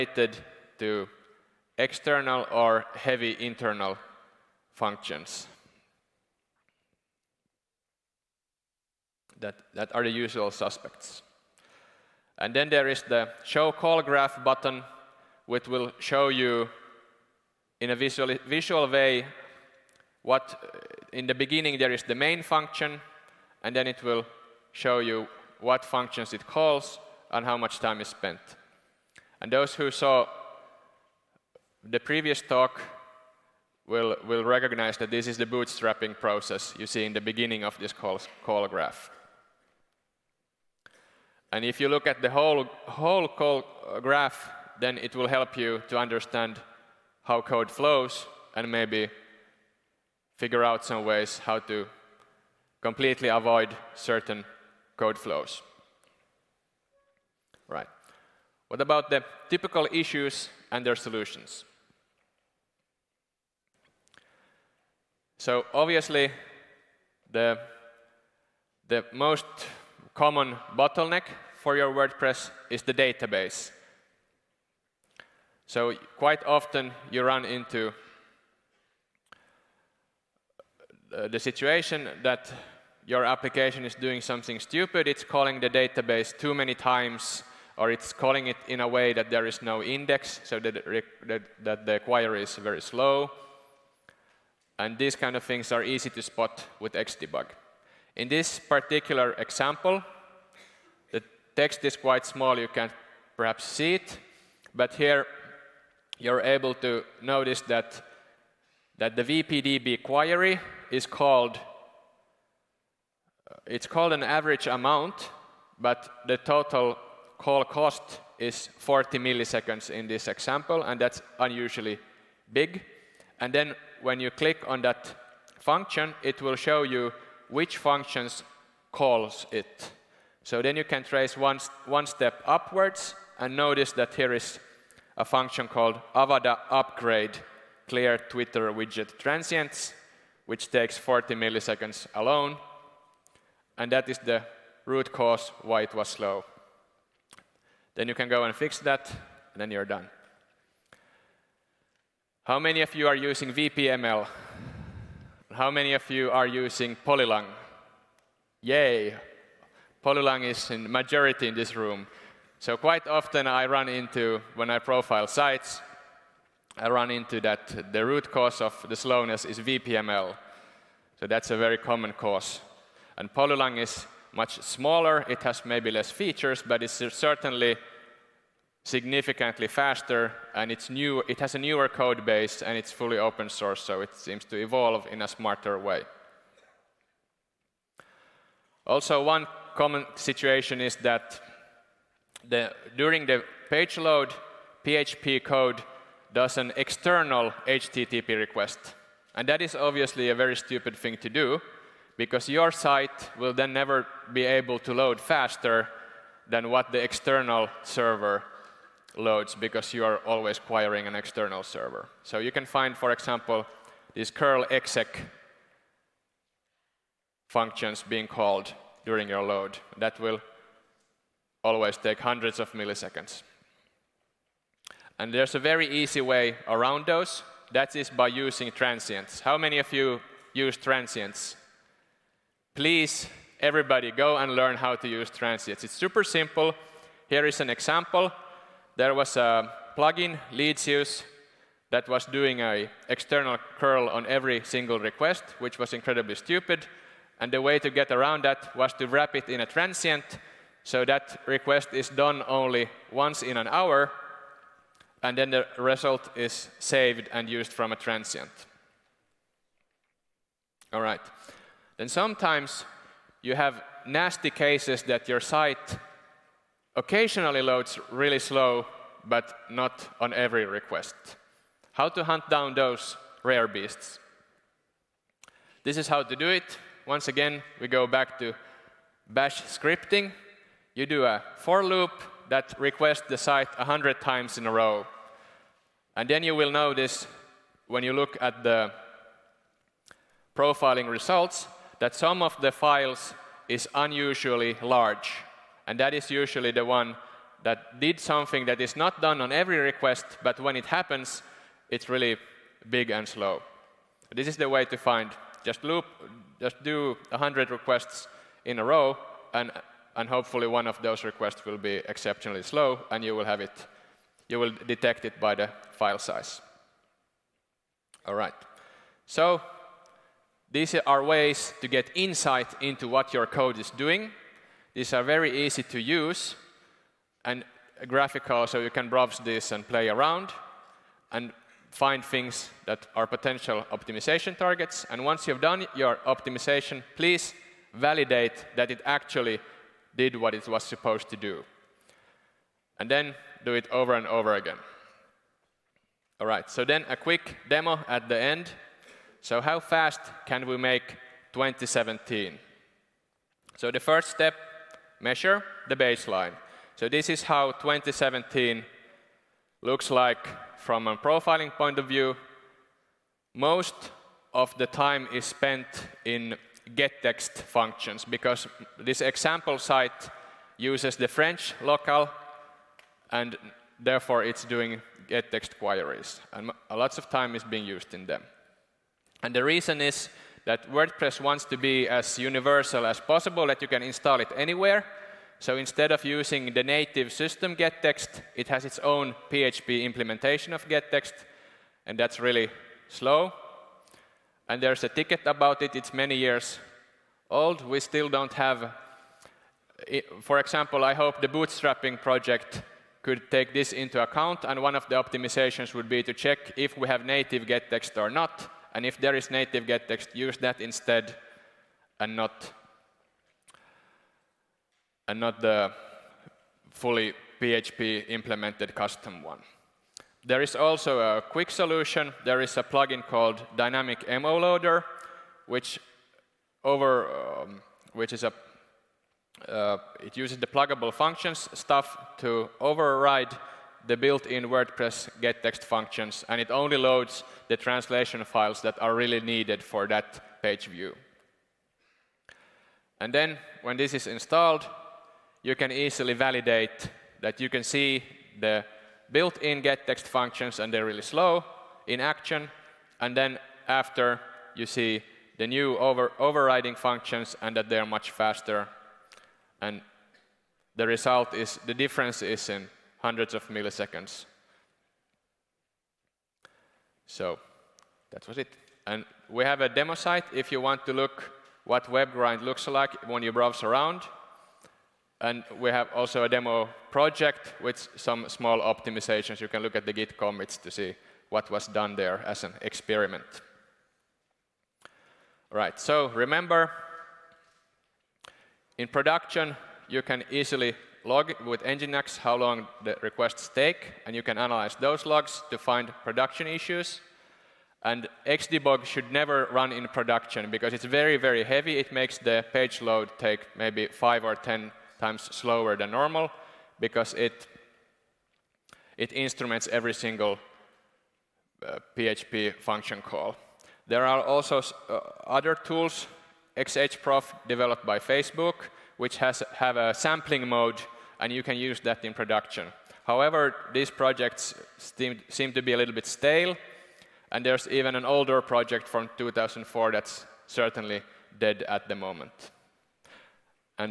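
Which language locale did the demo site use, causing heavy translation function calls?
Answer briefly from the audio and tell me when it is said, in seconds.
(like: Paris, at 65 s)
French, at 371 s.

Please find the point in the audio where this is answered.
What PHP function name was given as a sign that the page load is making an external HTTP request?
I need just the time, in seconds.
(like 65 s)
214 s.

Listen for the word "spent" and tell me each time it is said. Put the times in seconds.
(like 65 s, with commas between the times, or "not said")
28 s, 365 s.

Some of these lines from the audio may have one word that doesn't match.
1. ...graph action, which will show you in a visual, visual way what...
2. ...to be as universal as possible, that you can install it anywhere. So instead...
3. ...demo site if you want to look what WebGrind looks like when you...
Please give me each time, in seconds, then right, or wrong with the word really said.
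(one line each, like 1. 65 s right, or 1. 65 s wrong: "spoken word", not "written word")
1. 14 s wrong: "button", not "action"
2. 381 s right
3. 469 s right.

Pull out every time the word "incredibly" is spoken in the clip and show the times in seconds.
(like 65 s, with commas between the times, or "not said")
245 s.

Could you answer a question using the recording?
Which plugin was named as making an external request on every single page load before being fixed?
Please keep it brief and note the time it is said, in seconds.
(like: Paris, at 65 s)
Leadsius, at 240 s.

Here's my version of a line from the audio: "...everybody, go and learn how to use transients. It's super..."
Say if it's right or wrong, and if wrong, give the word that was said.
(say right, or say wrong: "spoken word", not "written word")
right.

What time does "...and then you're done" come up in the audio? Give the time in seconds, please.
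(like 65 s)
149 s.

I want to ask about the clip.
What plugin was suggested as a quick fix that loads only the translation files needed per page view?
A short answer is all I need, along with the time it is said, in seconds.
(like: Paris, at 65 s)
Dynamic MO Loader, at 423 s.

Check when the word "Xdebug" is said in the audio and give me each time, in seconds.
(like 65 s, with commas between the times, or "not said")
96 s, 498 s.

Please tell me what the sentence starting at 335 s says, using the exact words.
And once you've done your optimization, please validate that it actually did what it was supposed to do.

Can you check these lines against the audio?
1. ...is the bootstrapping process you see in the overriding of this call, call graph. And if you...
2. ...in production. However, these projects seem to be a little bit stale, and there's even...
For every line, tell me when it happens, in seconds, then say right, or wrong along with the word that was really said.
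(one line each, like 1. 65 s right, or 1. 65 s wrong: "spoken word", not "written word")
1. 35 s wrong: "beginning", not "overriding"
2. 522 s right.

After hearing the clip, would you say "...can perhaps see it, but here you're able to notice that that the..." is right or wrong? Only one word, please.
right.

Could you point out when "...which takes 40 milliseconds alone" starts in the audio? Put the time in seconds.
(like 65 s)
140 s.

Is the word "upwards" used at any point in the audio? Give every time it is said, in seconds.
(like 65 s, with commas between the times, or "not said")
132 s.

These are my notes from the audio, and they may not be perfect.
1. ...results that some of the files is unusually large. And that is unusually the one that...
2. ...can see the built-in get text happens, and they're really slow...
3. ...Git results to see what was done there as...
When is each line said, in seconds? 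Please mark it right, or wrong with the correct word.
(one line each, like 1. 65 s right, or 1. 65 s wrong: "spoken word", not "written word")
1. 291 s wrong: "usually", not "unusually"
2. 447 s wrong: "functions", not "happens"
3. 480 s wrong: "commits", not "results".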